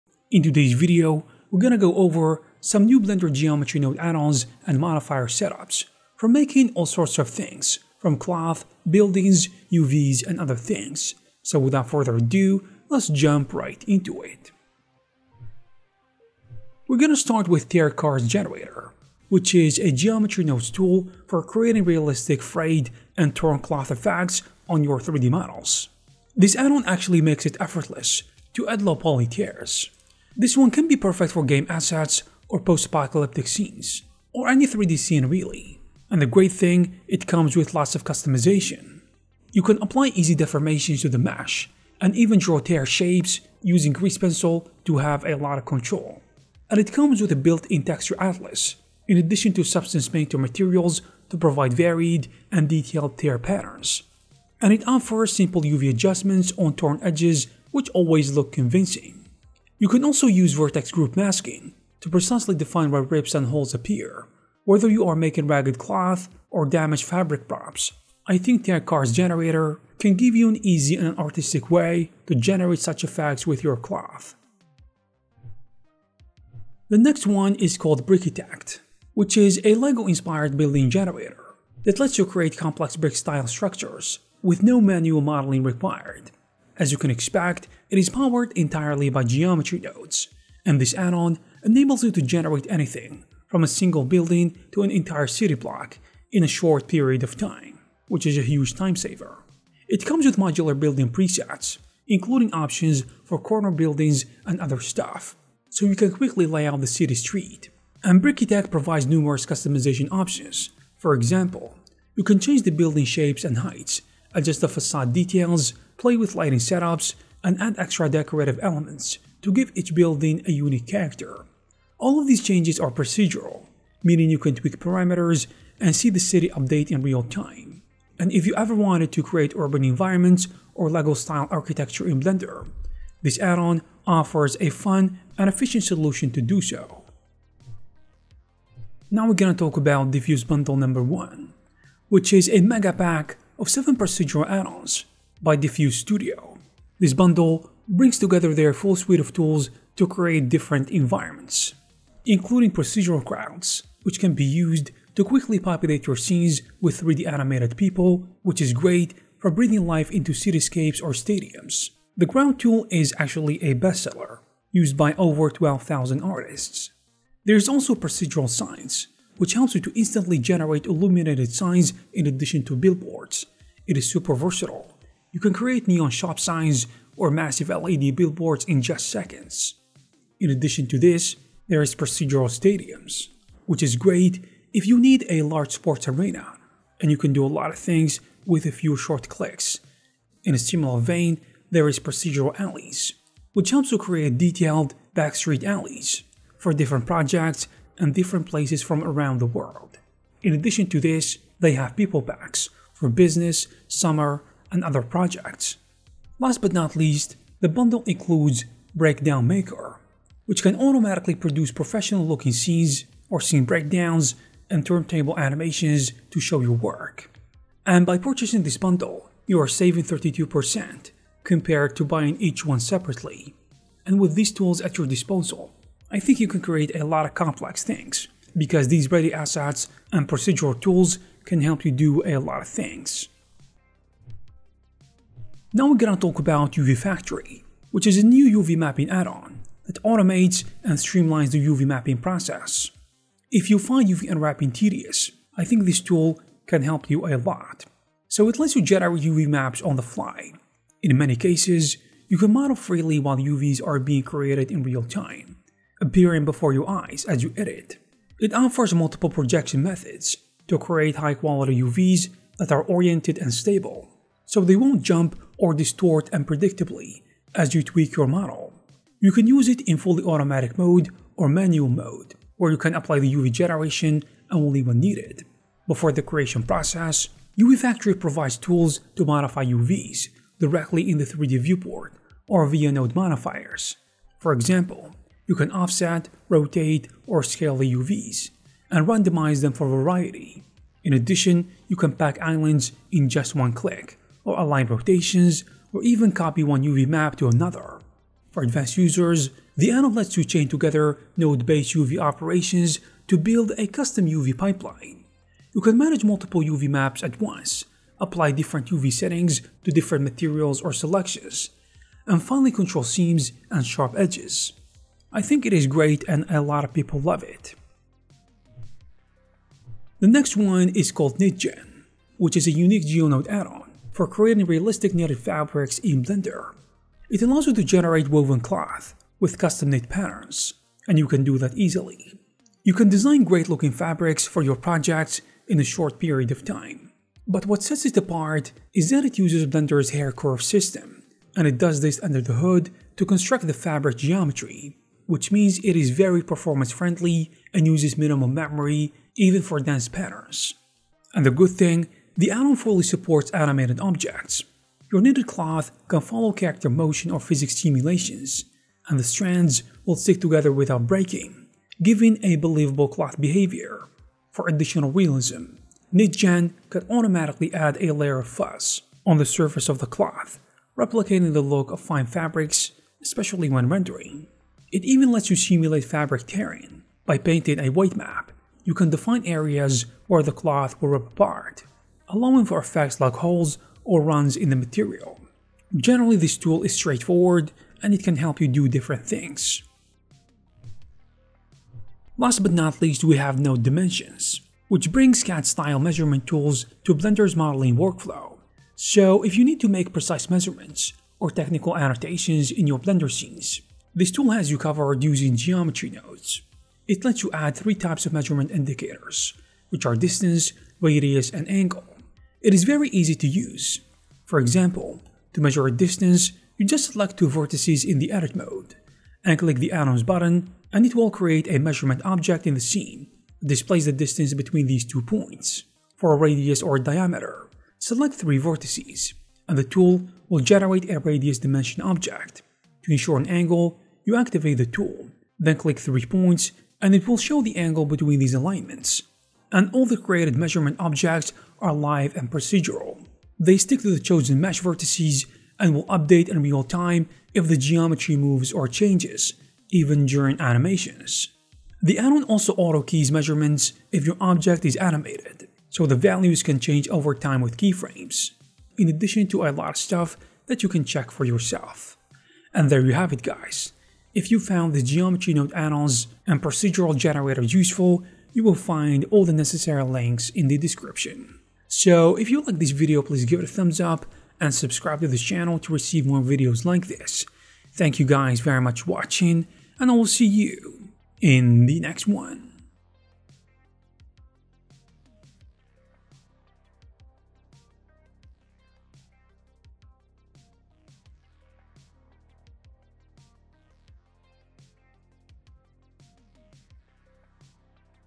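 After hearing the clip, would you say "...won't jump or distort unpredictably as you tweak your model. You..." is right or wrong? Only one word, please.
right.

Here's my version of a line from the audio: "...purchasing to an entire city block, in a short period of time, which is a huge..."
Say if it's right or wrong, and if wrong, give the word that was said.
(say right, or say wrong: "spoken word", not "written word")
wrong: "building", not "purchasing".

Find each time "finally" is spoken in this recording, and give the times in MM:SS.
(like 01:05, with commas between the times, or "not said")
05:12.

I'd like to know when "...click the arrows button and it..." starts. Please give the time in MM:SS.
06:59.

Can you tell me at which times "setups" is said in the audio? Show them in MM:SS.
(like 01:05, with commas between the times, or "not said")
00:05, 01:56.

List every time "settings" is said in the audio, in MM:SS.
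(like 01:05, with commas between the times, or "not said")
05:09.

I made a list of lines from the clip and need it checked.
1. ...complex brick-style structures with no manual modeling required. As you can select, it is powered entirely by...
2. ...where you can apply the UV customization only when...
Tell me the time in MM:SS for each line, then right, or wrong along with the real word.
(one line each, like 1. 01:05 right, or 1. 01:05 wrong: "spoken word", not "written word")
1. 01:22 wrong: "expect", not "select"
2. 04:32 wrong: "generation", not "customization".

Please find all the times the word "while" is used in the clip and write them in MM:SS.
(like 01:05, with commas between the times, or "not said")
04:13.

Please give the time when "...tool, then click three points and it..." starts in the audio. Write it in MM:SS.
07:14.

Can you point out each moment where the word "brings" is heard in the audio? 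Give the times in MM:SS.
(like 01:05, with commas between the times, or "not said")
02:27, 06:35.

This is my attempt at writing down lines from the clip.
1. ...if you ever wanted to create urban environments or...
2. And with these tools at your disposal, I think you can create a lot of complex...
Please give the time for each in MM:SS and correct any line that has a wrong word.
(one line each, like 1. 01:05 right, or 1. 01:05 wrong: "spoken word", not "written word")
1. 02:08 right
2. 03:44 right.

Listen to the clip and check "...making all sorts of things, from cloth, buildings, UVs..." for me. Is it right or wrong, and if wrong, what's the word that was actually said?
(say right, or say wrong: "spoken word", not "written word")
right.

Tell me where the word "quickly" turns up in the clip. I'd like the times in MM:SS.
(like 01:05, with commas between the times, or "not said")
01:46, 02:35.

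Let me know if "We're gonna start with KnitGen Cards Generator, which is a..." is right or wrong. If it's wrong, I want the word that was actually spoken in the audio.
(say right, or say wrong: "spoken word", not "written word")
wrong: "Tear", not "KnitGen".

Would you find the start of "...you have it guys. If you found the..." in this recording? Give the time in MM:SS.
07:43.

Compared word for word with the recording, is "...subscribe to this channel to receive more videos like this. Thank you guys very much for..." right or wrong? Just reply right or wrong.
right.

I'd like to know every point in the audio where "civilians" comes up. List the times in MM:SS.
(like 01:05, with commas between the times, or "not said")
not said.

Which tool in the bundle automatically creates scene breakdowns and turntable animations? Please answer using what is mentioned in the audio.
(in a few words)
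Breakdown Maker.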